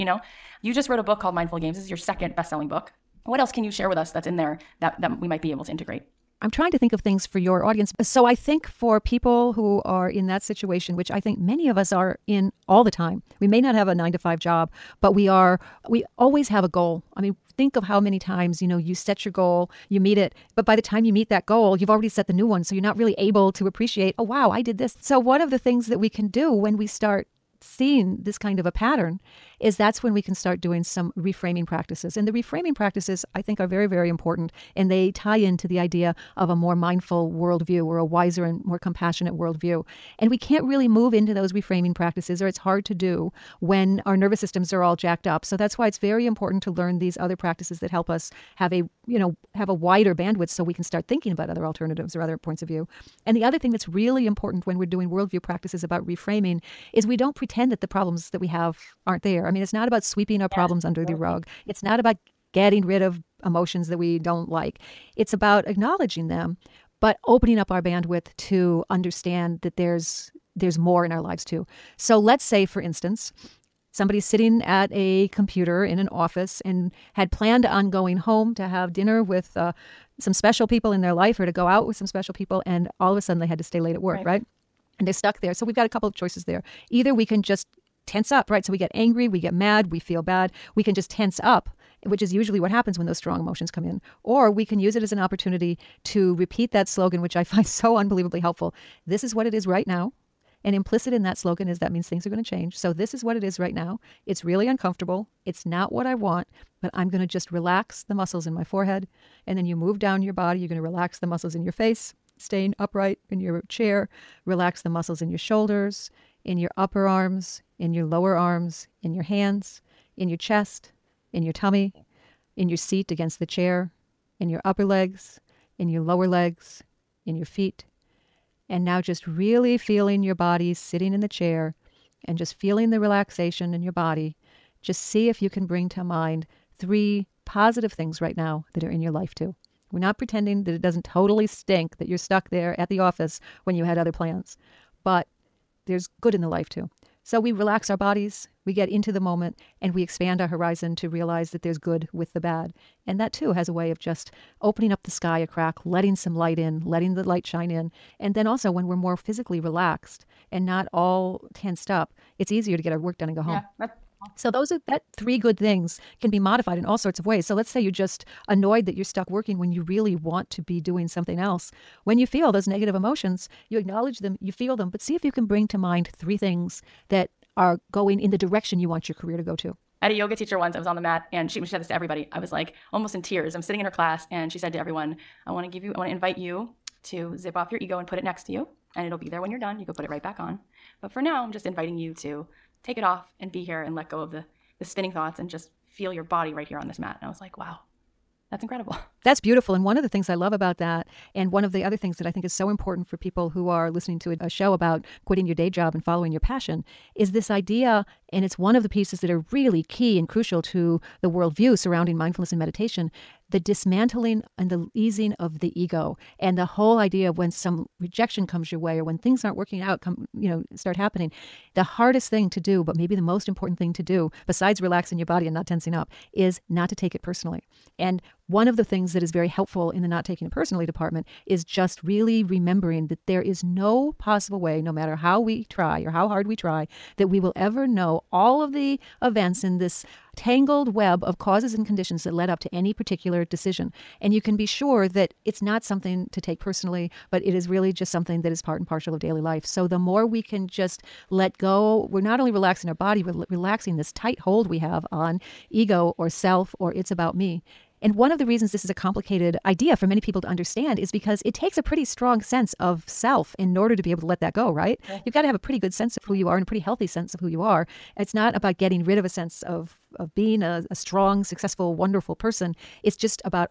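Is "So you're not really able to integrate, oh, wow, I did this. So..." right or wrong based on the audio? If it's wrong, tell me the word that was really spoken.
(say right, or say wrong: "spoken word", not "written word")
wrong: "appreciate", not "integrate".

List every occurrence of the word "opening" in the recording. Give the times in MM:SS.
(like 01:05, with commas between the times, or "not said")
01:07, 02:34.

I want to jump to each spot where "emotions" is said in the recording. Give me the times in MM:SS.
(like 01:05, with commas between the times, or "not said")
01:03, 01:33, 02:52.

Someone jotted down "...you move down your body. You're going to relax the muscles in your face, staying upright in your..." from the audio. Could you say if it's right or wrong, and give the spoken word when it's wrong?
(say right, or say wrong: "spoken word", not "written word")
right.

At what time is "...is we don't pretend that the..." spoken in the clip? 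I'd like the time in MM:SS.
00:56.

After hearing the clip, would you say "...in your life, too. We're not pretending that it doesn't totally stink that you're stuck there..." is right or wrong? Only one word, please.
right.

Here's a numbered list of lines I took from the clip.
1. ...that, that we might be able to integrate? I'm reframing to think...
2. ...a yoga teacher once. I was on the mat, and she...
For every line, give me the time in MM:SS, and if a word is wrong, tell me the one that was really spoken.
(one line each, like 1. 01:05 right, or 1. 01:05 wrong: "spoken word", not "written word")
1. 00:04 wrong: "trying", not "reframing"
2. 03:00 right.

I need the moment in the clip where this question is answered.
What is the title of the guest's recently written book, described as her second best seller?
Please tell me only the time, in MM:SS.
00:01.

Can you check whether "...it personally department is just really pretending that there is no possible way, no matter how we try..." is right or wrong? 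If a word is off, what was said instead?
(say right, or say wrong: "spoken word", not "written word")
wrong: "remembering", not "pretending".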